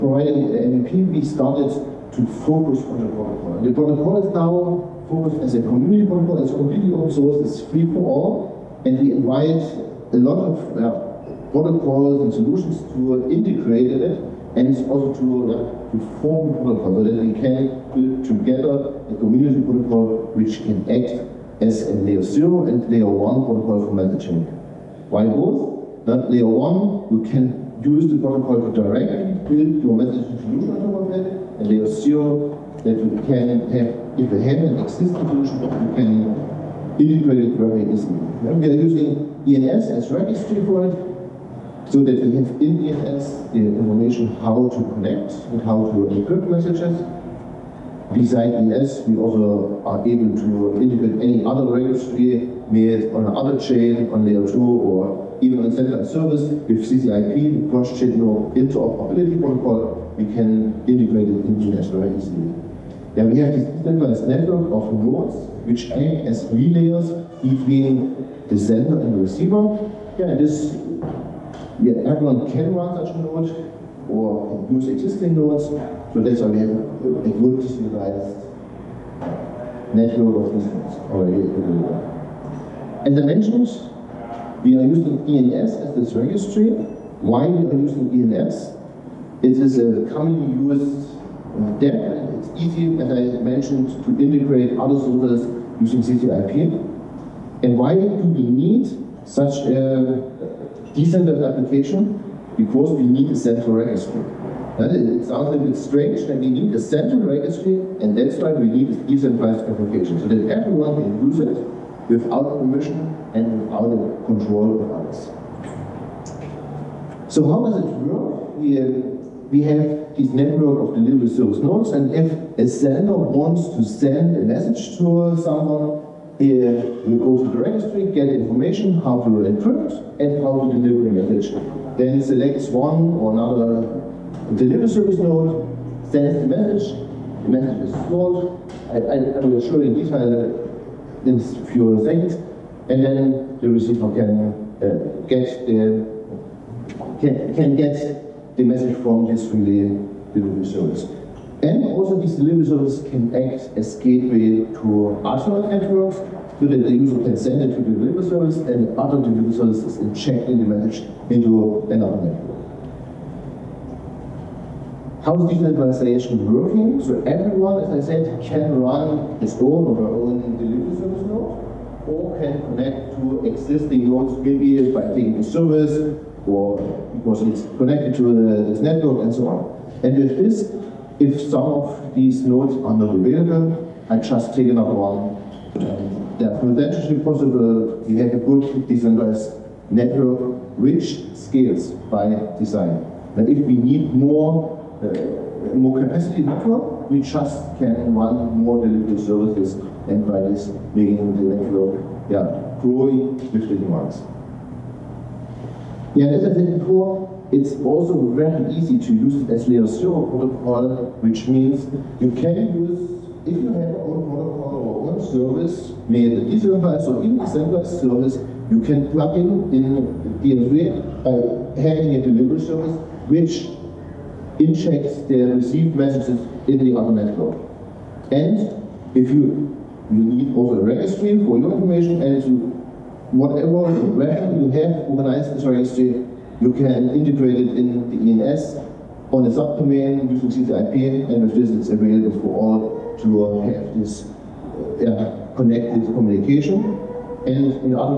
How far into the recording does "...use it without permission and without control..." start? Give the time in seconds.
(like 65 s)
111 s.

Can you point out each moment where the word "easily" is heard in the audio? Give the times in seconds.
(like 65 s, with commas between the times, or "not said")
37 s, 62 s.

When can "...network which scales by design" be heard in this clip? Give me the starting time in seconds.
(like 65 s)
189 s.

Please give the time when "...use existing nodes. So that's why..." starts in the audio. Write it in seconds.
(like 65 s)
74 s.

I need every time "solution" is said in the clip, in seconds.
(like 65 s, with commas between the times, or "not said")
12 s, 30 s, 35 s.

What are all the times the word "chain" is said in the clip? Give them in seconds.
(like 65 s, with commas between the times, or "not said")
53 s, 57 s.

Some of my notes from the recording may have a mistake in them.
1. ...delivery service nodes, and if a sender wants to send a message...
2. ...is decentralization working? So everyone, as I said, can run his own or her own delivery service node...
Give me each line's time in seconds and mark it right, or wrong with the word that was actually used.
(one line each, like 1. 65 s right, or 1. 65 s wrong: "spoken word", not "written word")
1. 120 s right
2. 165 s right.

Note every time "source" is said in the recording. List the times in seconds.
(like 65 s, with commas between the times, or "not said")
7 s, 94 s.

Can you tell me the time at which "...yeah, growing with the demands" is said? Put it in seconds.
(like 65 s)
202 s.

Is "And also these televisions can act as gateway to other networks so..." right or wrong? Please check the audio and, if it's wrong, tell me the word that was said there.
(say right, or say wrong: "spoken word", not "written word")
right.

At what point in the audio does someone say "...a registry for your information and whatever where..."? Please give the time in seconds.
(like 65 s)
230 s.